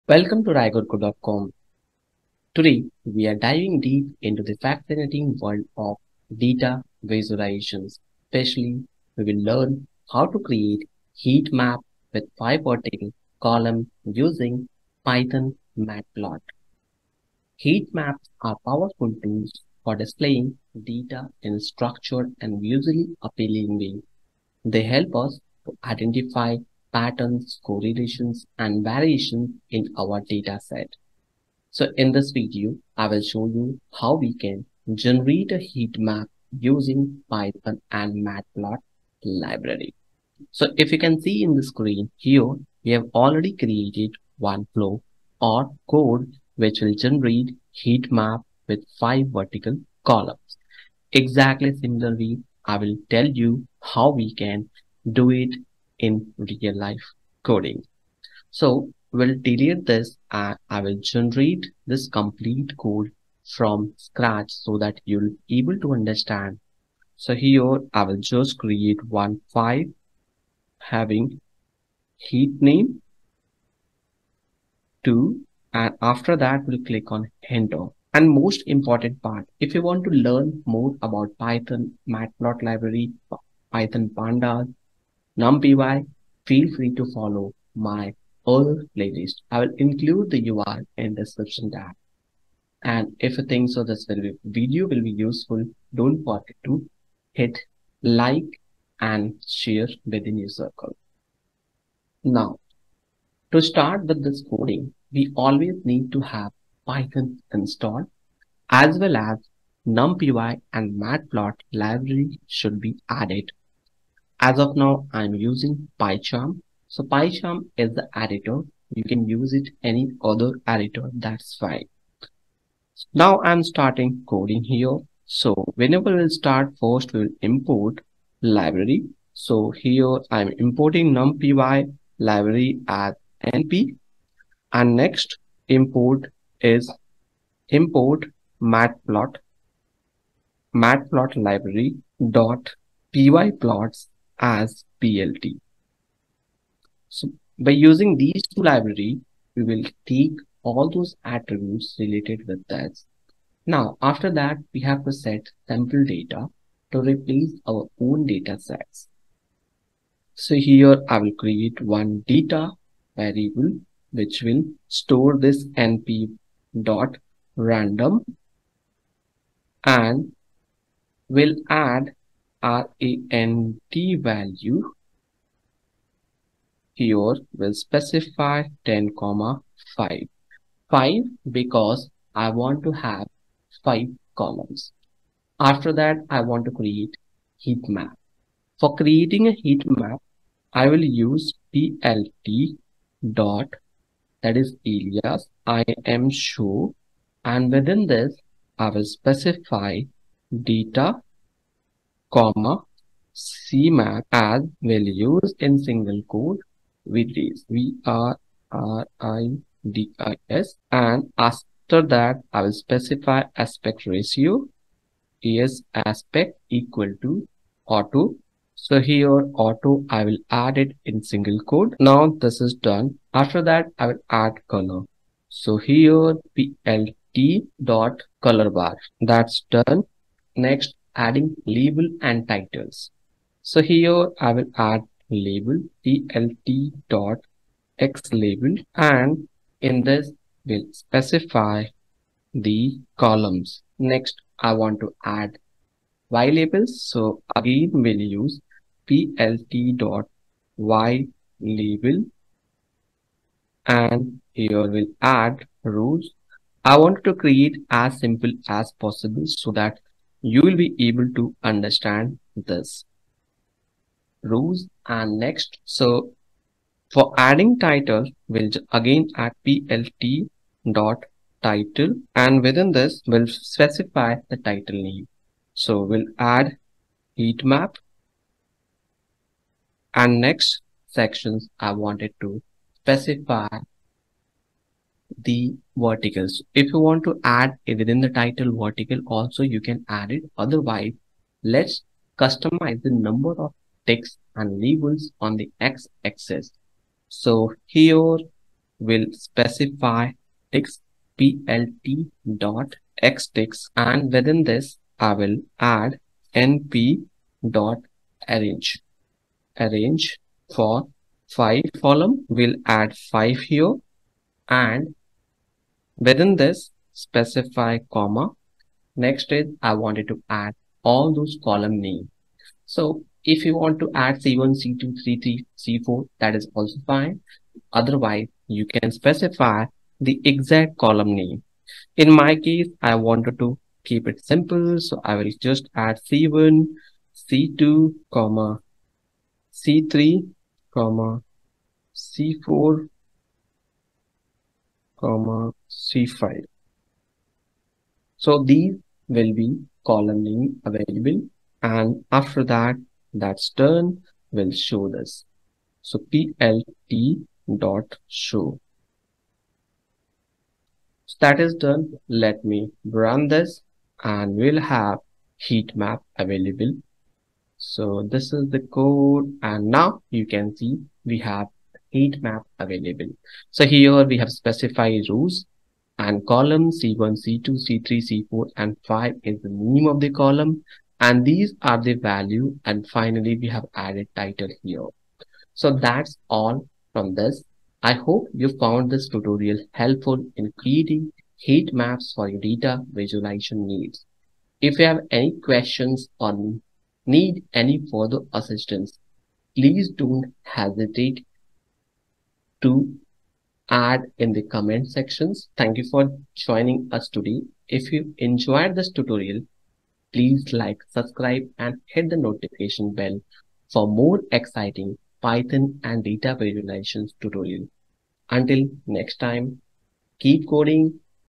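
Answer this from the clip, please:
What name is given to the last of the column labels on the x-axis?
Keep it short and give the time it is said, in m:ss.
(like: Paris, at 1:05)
C5, at 5:45.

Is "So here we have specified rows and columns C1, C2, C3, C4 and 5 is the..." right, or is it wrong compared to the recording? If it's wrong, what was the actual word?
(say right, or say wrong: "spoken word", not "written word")
right.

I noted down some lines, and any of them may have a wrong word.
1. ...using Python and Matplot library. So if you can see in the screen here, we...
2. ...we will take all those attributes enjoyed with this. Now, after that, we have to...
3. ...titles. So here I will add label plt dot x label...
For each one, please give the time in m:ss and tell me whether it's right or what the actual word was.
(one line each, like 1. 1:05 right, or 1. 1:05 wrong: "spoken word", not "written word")
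1. 0:36 right
2. 2:29 wrong: "related", not "enjoyed"
3. 3:52 right.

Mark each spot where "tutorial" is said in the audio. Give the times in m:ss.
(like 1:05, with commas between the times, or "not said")
6:29, 6:49, 6:57.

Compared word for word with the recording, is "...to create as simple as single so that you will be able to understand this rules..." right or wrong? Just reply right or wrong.
wrong.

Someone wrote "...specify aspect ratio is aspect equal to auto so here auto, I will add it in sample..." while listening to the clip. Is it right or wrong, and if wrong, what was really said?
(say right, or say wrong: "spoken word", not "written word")
wrong: "single", not "sample".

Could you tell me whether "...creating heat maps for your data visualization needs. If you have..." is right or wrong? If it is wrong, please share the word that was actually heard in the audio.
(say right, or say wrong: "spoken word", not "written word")
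right.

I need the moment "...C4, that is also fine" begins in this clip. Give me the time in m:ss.
5:25.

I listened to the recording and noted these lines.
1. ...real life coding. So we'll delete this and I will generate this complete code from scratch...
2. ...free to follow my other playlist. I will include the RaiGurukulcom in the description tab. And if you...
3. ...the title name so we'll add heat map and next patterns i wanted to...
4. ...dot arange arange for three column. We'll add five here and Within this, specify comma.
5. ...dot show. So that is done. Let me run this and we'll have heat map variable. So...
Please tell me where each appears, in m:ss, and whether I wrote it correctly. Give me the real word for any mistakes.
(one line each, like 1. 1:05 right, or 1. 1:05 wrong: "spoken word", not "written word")
1. 0:56 right
2. 1:26 wrong: "URL", not "RaiGurukulcom"
3. 4:34 wrong: "sections", not "patterns"
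4. 5:07 wrong: "five", not "three"
5. 5:57 wrong: "available", not "variable".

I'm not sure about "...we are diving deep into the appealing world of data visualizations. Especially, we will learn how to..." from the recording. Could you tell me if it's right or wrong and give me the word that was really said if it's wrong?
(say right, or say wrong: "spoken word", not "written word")
wrong: "fascinating", not "appealing".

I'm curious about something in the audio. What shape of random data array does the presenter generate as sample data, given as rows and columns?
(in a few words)
10 by 5.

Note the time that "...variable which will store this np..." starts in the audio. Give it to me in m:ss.
2:43.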